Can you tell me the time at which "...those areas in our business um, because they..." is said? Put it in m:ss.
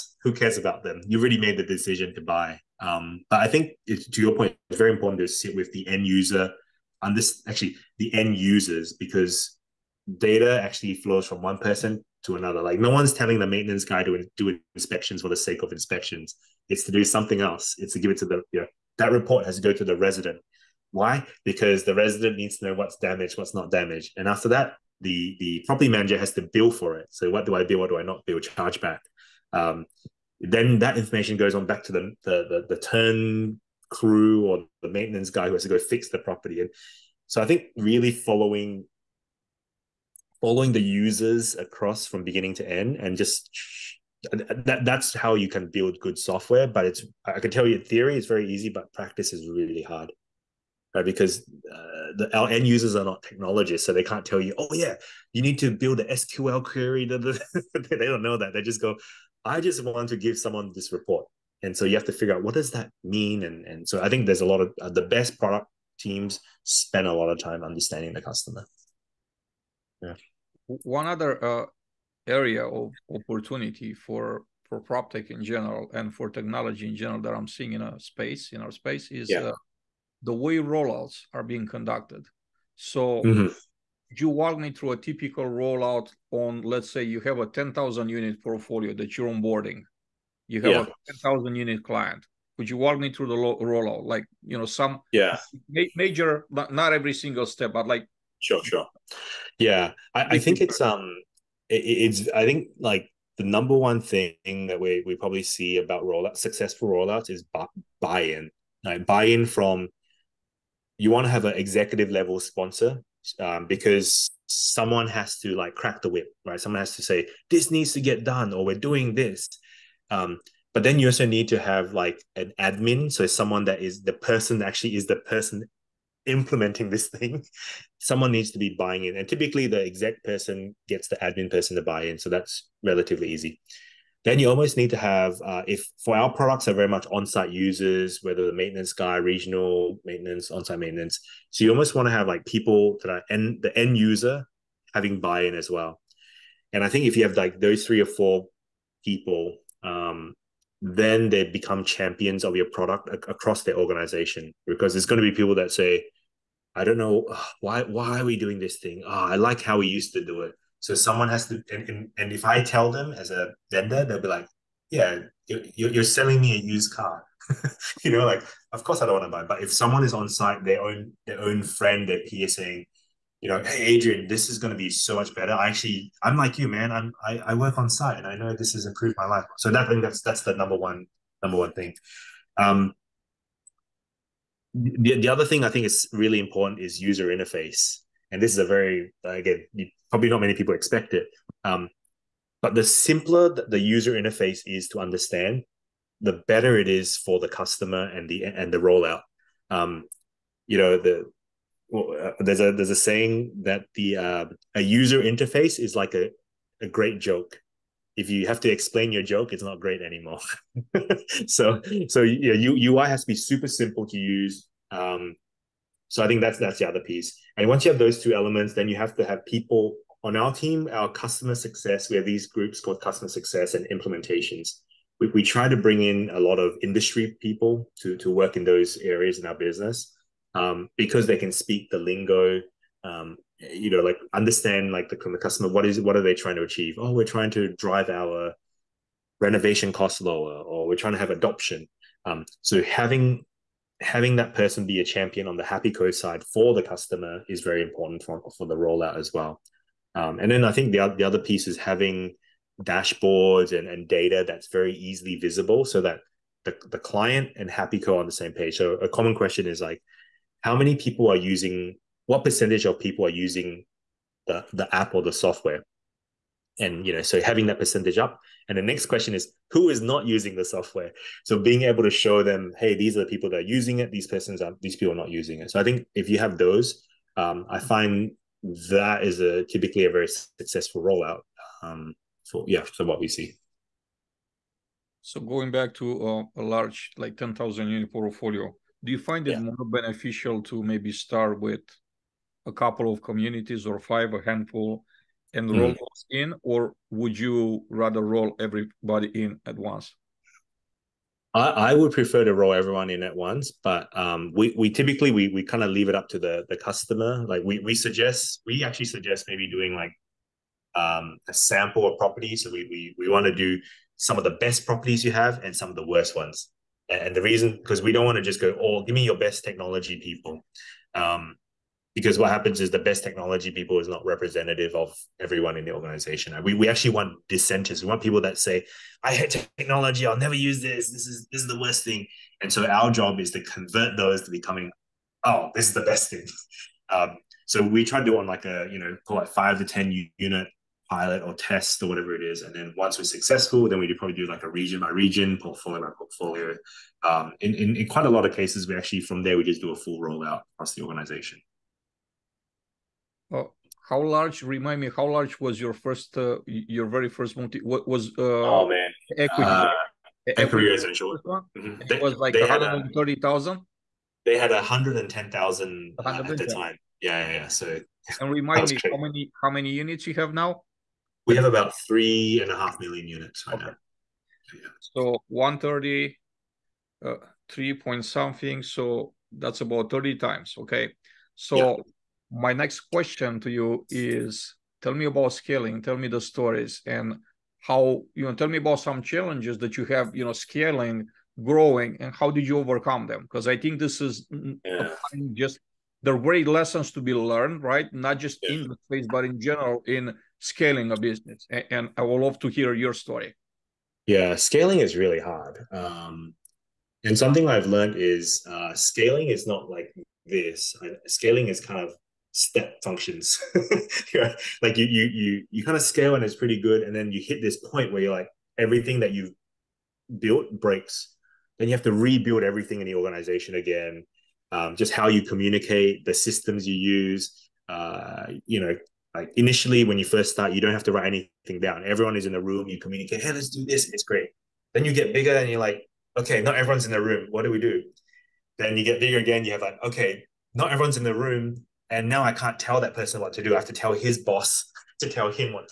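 3:48.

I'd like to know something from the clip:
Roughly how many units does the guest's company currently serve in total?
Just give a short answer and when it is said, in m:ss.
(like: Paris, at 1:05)
3.5 million, at 6:12.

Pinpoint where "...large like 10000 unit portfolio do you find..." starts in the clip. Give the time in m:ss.
4:46.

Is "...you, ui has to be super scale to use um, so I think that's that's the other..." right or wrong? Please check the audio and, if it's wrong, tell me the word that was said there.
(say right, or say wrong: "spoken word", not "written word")
wrong: "simple", not "scale".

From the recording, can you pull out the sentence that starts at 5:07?
Like we, we suggest we actually suggest maybe doing like um, a sample of properties.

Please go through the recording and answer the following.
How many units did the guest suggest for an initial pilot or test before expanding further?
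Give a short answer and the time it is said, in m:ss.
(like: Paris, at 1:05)
5 to 10, at 5:39.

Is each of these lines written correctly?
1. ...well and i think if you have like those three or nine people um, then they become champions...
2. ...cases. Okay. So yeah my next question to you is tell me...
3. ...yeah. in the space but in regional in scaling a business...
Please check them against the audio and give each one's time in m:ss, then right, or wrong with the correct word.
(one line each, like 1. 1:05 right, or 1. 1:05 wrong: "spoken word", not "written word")
1. 2:25 wrong: "four", not "nine"
2. 6:20 wrong: "times", not "cases"
3. 6:38 wrong: "general", not "regional".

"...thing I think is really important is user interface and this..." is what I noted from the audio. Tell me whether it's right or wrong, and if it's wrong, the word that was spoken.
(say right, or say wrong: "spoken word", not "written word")
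right.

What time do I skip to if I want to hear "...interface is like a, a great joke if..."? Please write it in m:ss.
3:25.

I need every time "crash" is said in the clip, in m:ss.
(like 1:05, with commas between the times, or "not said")
not said.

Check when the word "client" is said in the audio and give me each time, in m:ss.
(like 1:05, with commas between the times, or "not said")
1:31, 4:16.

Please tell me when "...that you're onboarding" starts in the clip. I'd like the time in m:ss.
1:28.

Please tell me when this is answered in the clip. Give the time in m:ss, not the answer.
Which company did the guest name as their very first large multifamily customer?
6:00.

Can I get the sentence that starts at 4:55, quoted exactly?
roll those in, or would you rather roll everybody in at once?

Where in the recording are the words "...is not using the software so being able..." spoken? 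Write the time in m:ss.
4:29.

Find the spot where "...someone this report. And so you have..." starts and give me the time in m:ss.
1:00.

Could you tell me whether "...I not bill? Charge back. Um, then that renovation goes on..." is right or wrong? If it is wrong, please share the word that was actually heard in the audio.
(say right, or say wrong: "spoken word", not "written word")
wrong: "information", not "renovation".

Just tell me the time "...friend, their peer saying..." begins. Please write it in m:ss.
2:51.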